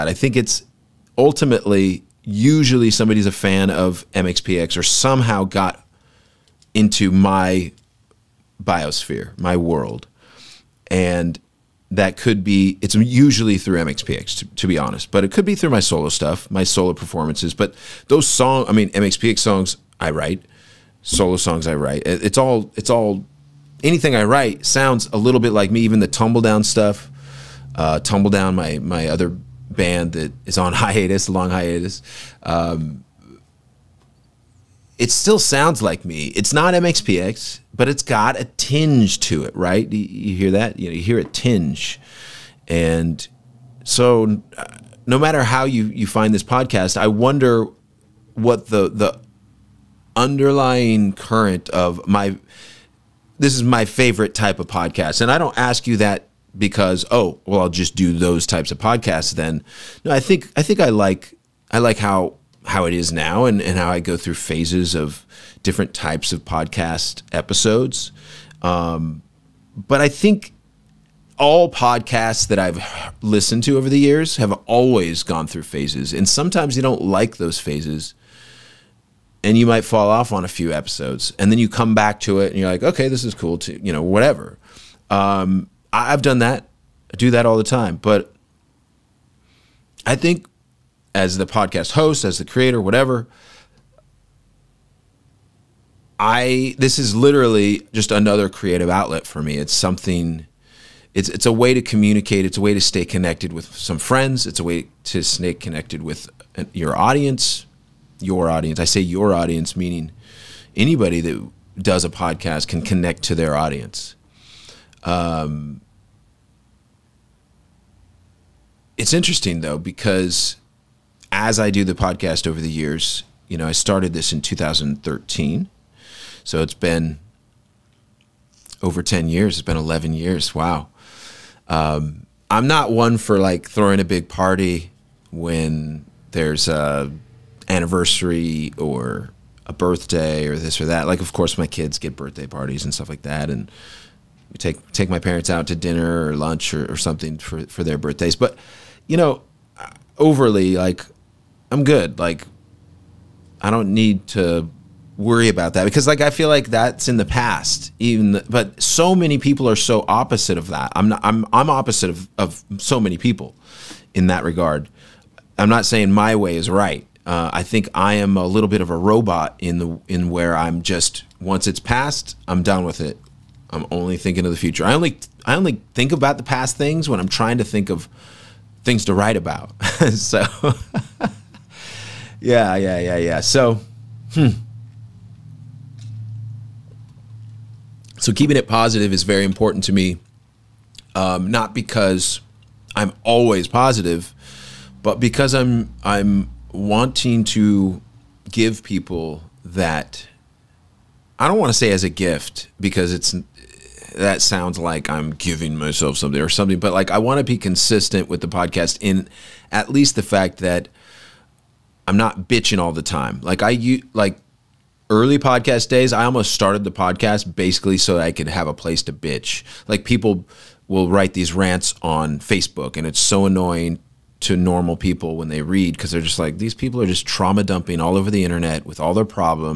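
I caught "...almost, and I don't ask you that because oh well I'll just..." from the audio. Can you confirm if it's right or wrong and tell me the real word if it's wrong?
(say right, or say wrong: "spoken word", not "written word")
wrong: "podcast", not "almost".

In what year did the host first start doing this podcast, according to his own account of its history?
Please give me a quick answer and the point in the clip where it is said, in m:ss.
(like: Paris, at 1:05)
2013, at 2:04.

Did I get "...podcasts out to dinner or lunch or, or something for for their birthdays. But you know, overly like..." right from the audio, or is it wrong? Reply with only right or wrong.
wrong.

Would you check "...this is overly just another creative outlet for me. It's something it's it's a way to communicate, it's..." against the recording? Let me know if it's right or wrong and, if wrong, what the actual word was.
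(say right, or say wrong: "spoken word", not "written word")
wrong: "literally", not "overly".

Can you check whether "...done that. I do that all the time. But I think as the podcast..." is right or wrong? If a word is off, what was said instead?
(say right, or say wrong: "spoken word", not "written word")
right.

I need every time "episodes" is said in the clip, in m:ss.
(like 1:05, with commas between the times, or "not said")
1:07, 1:20.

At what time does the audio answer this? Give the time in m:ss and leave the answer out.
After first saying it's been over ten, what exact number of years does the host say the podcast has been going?
2:09.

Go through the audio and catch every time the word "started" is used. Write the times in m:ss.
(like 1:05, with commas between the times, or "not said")
2:03, 3:36.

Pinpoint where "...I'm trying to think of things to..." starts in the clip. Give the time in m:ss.
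2:57.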